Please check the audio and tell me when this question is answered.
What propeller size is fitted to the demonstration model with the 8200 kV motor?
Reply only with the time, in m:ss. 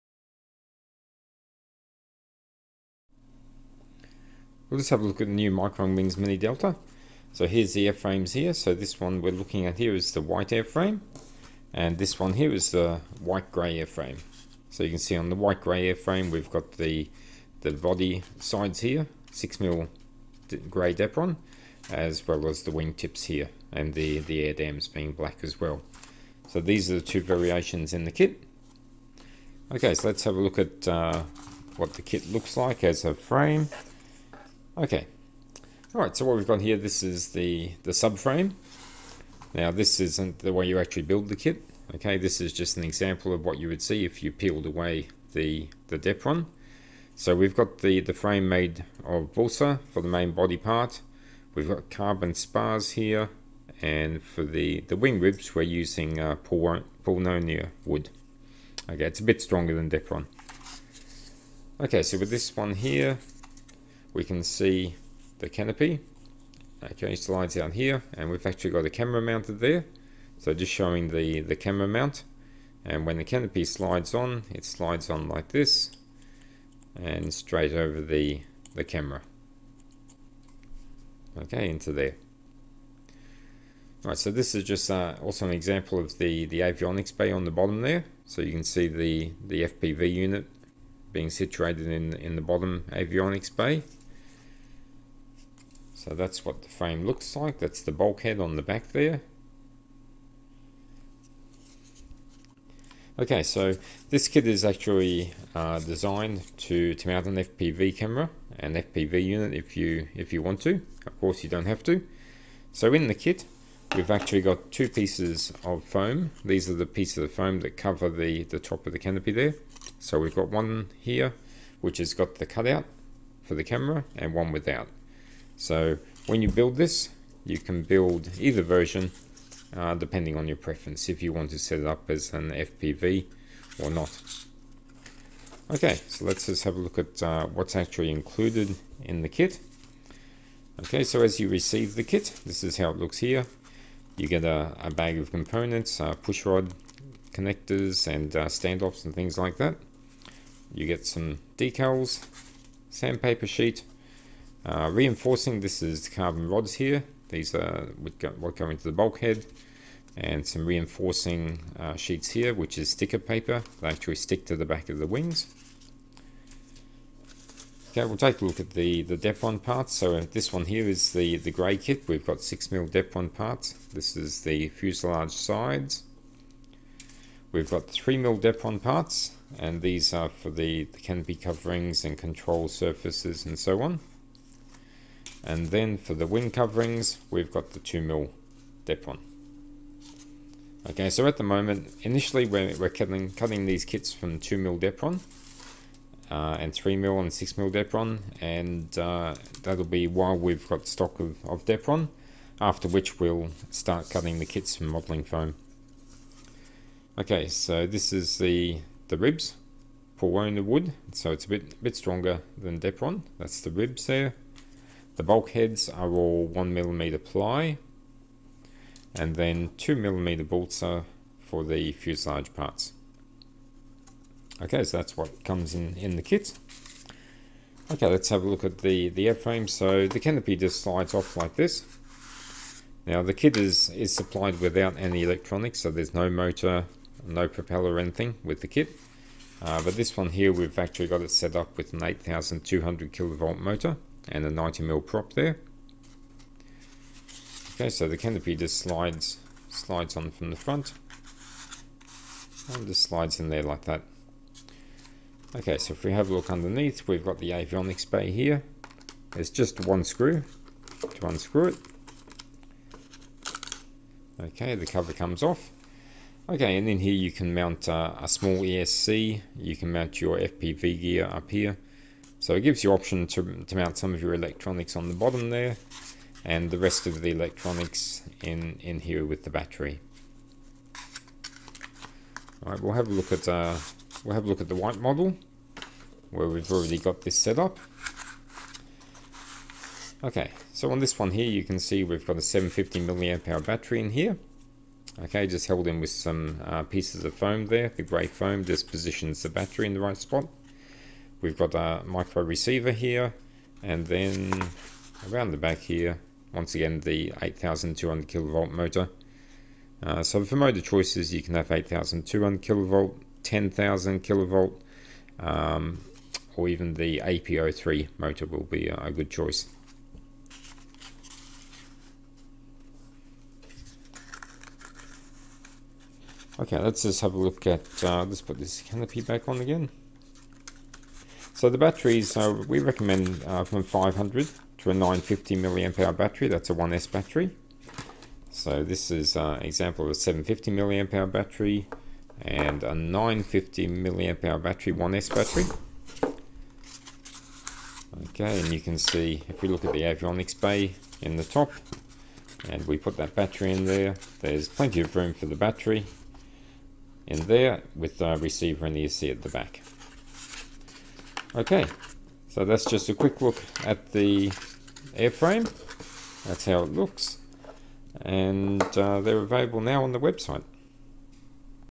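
4:04.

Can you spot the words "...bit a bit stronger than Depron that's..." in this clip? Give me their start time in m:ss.
3:31.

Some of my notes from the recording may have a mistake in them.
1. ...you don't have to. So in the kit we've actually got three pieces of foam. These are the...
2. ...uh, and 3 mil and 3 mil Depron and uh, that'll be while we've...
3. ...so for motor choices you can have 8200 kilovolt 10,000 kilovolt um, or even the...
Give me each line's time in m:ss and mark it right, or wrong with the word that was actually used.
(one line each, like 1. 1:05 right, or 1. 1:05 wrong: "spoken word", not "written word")
1. 1:51 wrong: "two", not "three"
2. 3:16 wrong: "6", not "3"
3. 5:10 right.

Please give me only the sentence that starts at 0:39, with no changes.
Now this isn't the way you actually build the kit.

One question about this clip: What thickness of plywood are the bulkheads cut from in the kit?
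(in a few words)
1mm.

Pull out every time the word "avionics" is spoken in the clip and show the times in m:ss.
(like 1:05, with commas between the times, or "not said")
1:26, 1:32, 4:17, 5:50.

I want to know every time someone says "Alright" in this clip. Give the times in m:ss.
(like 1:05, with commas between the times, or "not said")
4:42.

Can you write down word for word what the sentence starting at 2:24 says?
You get a, a bag of components, uh, push rod, connectors and uh, standoffs and things like that.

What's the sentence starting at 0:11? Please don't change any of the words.
And this one here is the white grey airframe.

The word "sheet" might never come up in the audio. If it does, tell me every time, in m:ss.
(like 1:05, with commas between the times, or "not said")
2:33, 2:41.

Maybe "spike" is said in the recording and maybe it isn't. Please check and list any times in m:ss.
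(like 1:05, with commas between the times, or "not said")
not said.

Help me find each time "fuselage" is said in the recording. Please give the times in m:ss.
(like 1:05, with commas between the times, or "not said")
2:54, 3:41.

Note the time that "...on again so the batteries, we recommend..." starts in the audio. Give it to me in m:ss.
5:29.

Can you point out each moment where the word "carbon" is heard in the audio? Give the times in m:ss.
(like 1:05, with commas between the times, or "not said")
0:51, 2:36.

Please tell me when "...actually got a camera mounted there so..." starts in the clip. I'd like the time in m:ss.
1:08.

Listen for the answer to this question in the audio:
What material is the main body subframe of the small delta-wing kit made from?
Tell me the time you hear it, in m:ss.
0:49.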